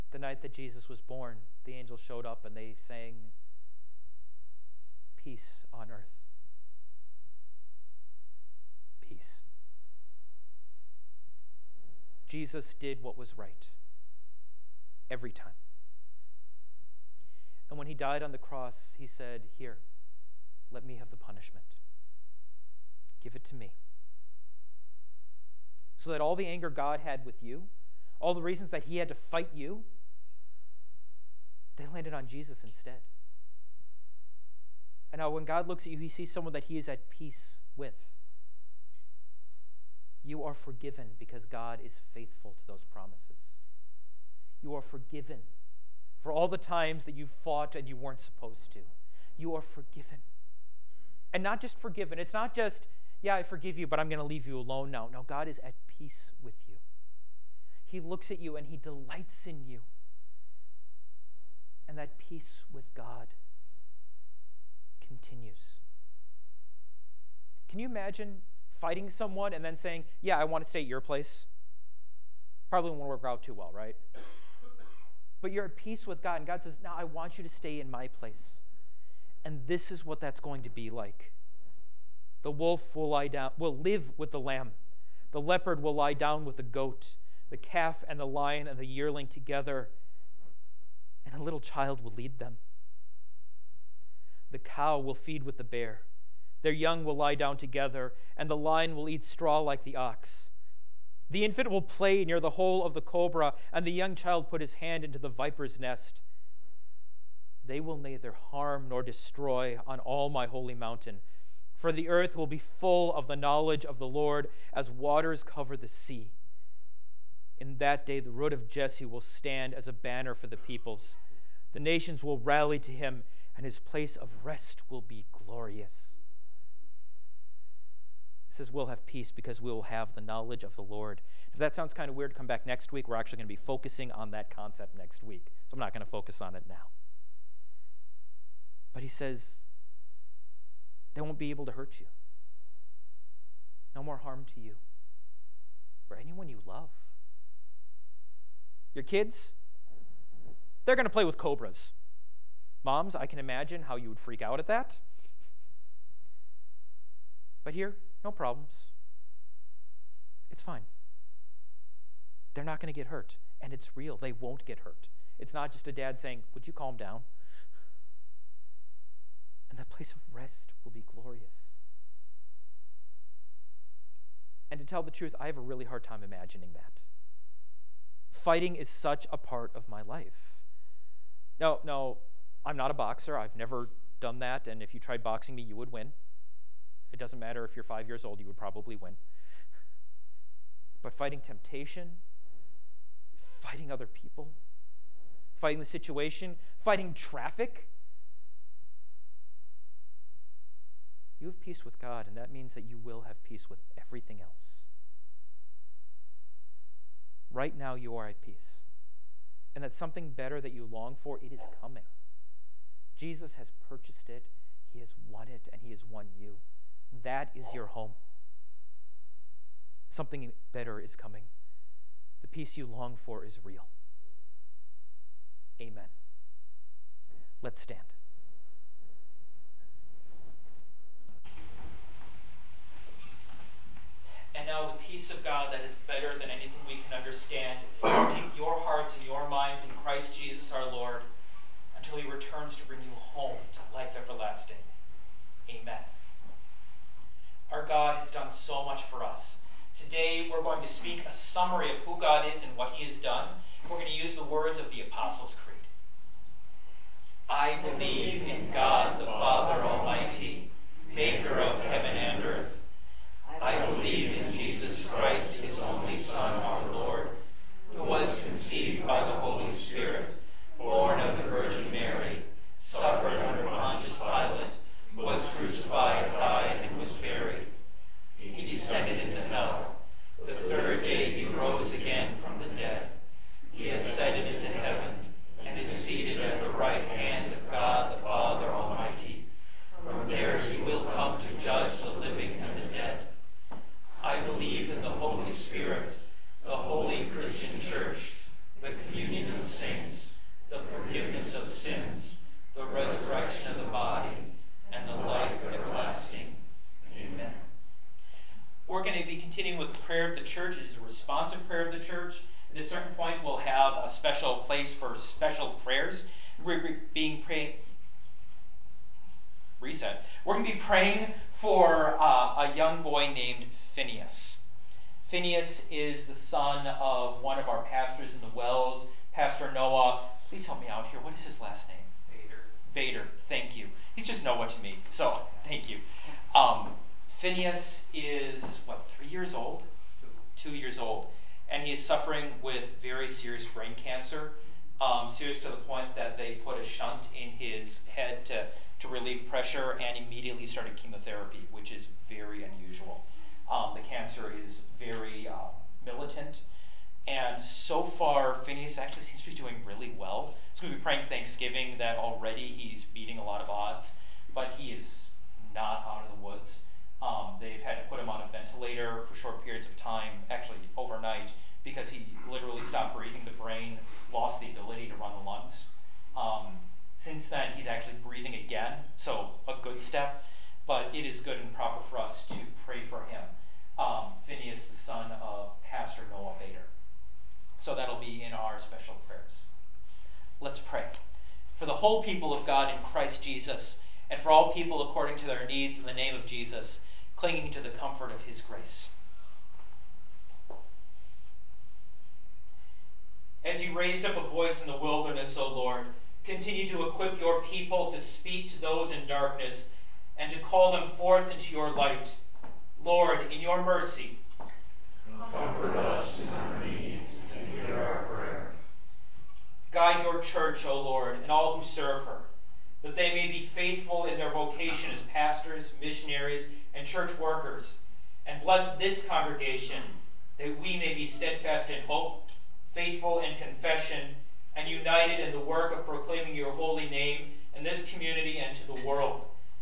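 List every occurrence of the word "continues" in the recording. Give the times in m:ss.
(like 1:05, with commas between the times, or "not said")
1:05, 6:46.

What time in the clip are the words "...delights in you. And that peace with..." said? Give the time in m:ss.
0:58.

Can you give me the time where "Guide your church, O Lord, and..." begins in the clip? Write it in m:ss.
6:59.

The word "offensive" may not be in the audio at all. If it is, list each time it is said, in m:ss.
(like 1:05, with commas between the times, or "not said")
not said.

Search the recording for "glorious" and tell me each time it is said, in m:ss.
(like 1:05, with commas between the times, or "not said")
2:05, 2:51.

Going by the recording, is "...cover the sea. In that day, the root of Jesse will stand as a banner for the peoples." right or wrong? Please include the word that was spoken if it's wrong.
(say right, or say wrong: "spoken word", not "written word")
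right.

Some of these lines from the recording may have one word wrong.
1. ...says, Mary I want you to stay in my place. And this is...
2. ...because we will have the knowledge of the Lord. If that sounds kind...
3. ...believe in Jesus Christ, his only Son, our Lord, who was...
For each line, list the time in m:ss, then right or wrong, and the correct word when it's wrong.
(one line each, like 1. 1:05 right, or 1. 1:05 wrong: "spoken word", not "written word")
1. 1:16 wrong: "Now", not "Mary"
2. 2:09 right
3. 4:23 right.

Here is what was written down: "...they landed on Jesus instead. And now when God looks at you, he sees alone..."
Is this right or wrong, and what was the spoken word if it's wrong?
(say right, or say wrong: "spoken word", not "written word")
wrong: "someone", not "alone".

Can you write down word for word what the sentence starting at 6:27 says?
So that'll be in our special prayers.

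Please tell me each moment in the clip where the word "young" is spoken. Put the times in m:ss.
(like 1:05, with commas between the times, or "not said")
1:36, 1:43.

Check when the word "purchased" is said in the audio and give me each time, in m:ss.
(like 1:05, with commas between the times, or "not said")
3:33.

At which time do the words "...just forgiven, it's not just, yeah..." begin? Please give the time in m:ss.
0:51.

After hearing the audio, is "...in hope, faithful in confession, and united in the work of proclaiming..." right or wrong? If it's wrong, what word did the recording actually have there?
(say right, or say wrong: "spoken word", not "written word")
right.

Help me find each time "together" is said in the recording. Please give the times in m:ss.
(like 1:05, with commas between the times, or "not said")
1:29, 1:37.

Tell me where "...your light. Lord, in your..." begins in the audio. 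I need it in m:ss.
6:51.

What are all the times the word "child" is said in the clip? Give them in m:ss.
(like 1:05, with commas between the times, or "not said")
1:31, 1:44.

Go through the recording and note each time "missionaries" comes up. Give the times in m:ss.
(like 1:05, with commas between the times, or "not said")
7:05.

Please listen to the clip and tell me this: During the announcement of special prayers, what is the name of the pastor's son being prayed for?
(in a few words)
Phineas.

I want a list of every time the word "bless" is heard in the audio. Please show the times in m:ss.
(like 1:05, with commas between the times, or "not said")
7:08.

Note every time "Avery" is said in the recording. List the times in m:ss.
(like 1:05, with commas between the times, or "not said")
not said.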